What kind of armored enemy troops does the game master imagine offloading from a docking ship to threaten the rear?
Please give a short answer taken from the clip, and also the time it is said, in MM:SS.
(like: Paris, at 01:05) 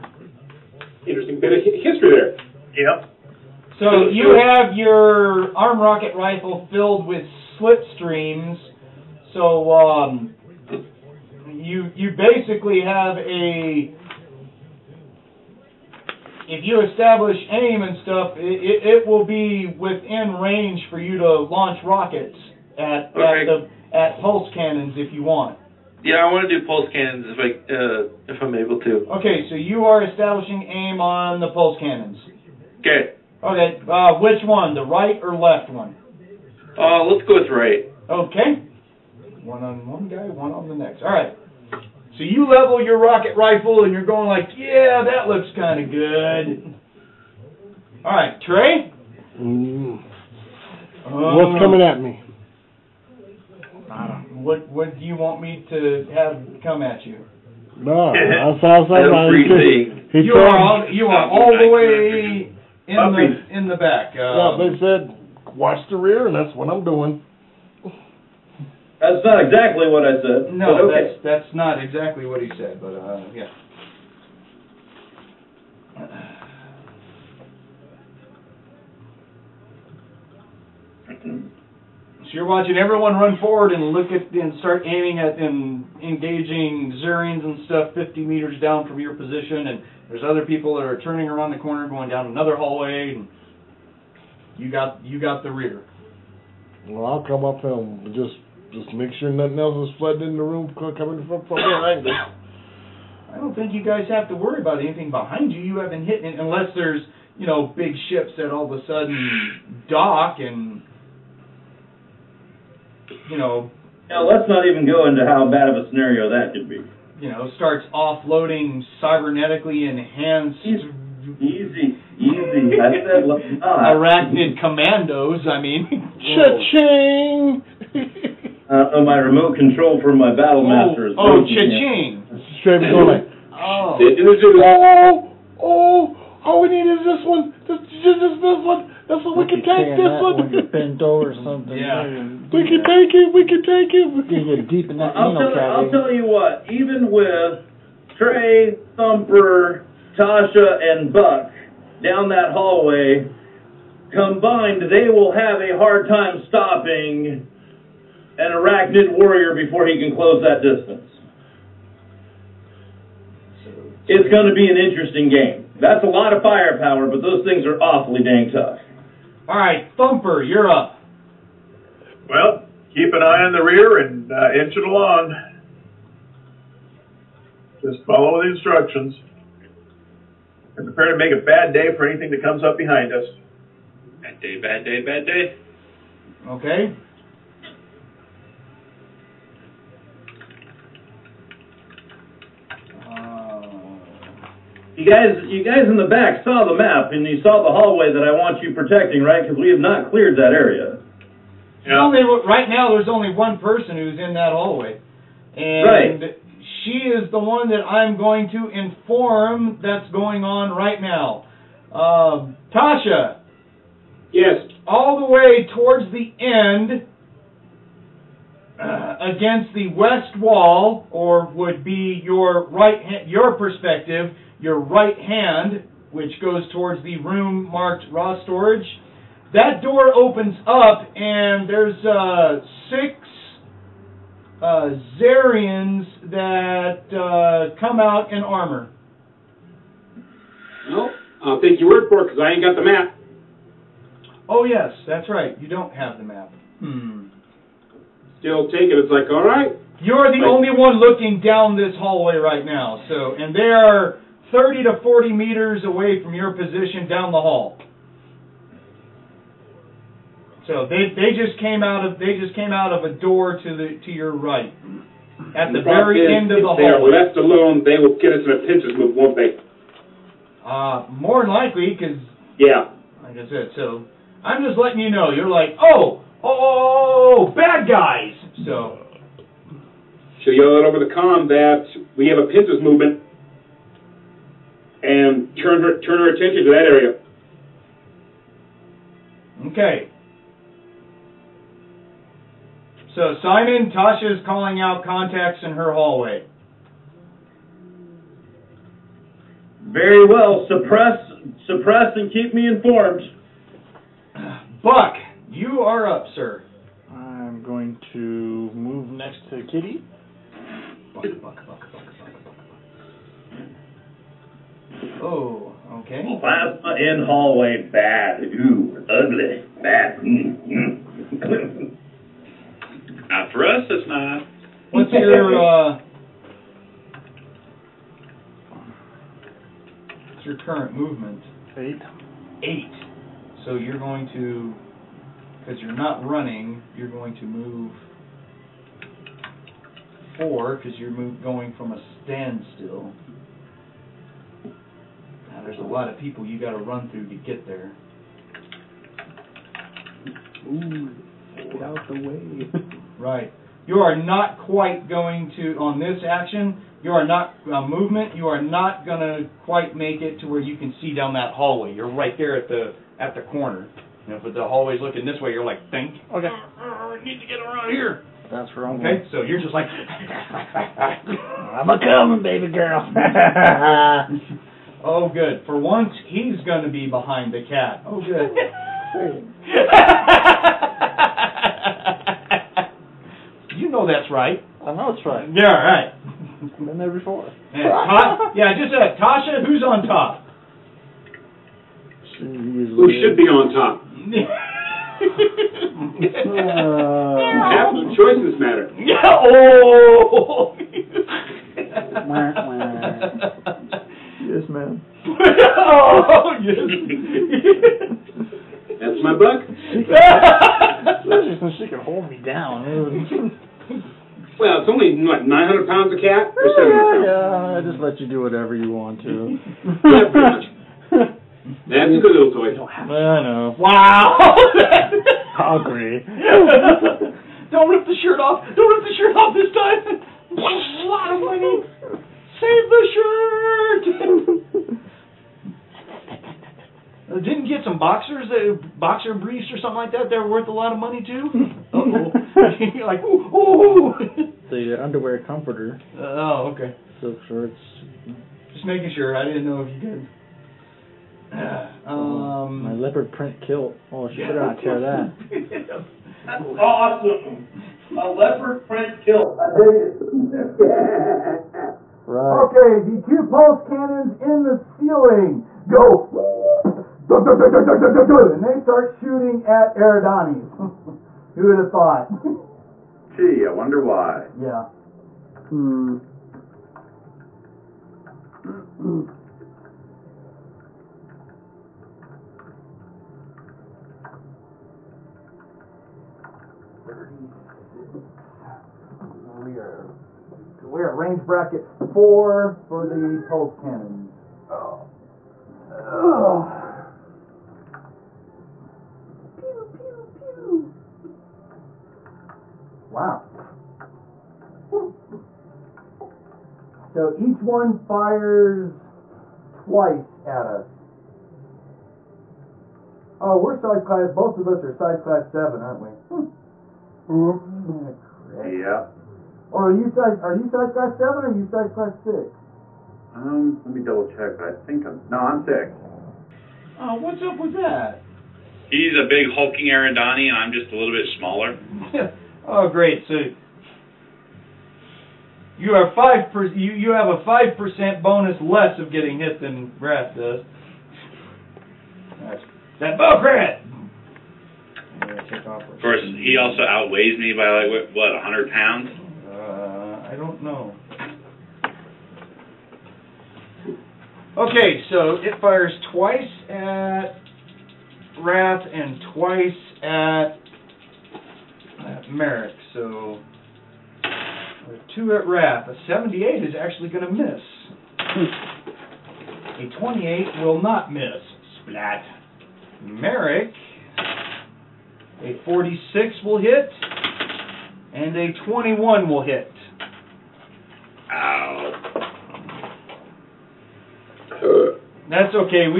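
Arachnid commandos, at 02:03.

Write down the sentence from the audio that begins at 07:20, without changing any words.
They're worth a lot of money too.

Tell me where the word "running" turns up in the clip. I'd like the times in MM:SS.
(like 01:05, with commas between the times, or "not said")
05:36.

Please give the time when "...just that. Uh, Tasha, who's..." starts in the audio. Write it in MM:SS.
06:28.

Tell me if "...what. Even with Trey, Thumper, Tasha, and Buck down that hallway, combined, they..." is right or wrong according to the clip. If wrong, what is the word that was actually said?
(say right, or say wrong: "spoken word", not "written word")
right.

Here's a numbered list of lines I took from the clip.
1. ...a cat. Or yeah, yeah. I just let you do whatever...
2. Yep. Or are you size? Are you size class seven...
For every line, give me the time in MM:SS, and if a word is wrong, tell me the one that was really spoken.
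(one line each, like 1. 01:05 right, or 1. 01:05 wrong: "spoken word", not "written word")
1. 06:56 right
2. 08:38 right.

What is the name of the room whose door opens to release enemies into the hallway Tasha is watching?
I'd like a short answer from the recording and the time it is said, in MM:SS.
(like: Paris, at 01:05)
raw storage, at 03:48.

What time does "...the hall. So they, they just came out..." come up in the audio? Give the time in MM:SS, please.
04:17.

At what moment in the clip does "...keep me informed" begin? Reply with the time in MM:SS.
05:02.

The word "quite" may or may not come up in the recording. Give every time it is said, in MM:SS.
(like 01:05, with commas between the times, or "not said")
05:54, 05:59.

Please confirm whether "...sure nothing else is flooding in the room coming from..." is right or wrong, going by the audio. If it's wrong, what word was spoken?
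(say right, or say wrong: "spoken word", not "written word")
right.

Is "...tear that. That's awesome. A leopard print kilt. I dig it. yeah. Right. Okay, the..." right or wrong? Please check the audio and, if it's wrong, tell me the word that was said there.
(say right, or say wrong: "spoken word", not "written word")
right.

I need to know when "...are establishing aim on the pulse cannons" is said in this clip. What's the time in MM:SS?
00:29.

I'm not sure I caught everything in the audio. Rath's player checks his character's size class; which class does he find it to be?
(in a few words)
6.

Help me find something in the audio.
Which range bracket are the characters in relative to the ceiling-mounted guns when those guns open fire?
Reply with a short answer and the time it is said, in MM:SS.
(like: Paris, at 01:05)
4, at 08:11.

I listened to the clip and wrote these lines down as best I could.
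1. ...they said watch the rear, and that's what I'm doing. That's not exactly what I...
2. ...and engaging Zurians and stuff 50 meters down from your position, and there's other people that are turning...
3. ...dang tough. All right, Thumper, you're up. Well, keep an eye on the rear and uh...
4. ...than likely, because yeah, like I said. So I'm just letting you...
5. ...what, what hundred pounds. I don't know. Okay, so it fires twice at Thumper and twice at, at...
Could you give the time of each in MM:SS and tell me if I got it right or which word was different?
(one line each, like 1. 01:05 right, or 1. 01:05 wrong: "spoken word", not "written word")
1. 01:04 right
2. 01:25 right
3. 02:48 right
4. 04:31 right
5. 09:07 wrong: "Rath", not "Thumper".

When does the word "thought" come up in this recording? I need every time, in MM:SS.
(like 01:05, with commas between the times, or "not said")
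07:51.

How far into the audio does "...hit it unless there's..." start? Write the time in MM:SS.
01:46.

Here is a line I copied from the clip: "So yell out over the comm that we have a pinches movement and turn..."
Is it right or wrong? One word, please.
right.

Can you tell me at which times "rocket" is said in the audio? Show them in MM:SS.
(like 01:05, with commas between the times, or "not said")
00:05, 00:21, 00:42.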